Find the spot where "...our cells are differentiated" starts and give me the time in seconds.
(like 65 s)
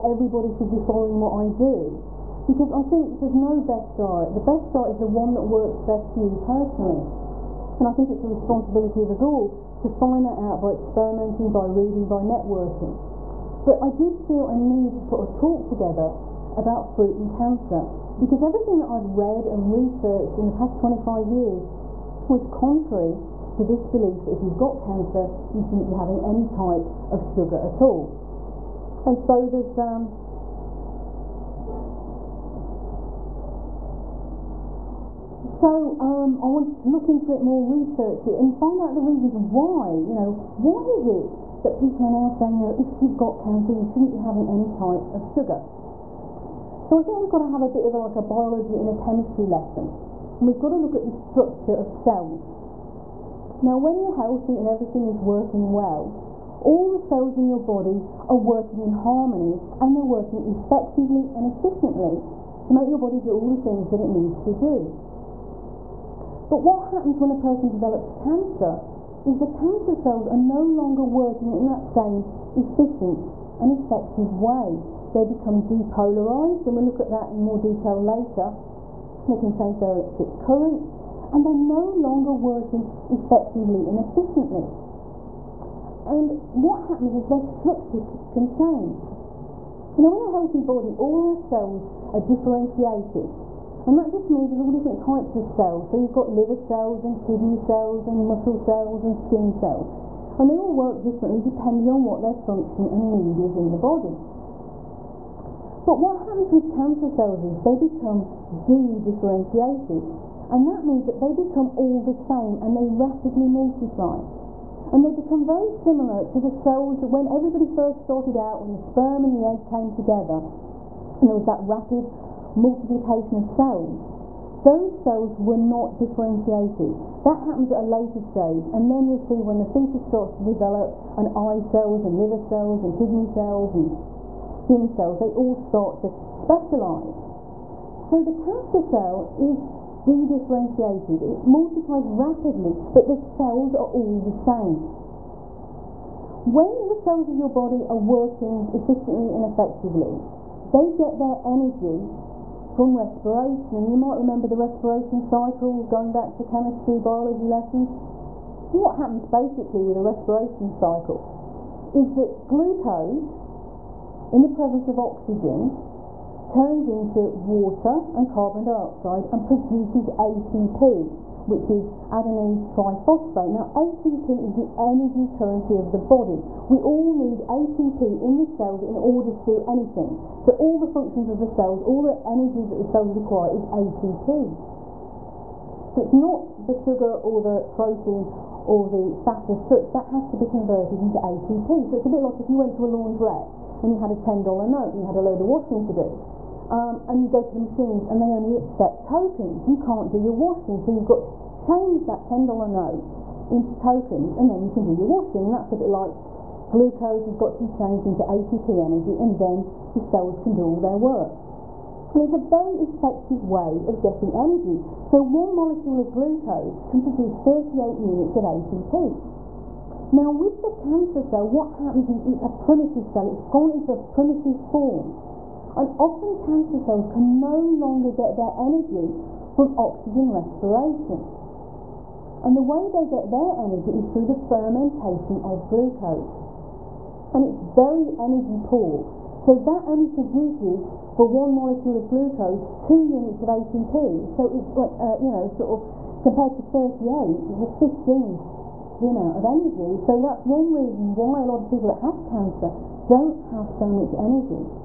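91 s.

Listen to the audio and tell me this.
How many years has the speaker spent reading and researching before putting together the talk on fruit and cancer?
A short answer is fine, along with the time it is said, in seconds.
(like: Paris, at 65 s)
25 years, at 20 s.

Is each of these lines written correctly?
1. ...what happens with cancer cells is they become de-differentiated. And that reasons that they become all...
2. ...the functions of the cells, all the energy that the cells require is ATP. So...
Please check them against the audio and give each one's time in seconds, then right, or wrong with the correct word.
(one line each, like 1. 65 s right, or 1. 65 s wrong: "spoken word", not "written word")
1. 105 s wrong: "means", not "reasons"
2. 180 s right.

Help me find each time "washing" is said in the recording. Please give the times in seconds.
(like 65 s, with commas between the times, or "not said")
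195 s, 200 s, 205 s.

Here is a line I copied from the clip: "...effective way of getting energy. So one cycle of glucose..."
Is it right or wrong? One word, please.
wrong.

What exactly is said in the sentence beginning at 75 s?
They become depolarized, and we'll look at that in more detail later.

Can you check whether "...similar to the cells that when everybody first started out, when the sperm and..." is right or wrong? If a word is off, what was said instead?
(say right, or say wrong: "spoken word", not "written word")
right.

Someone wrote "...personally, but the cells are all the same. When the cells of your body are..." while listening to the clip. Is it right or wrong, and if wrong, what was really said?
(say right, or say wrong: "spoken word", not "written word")
wrong: "rapidly", not "personally".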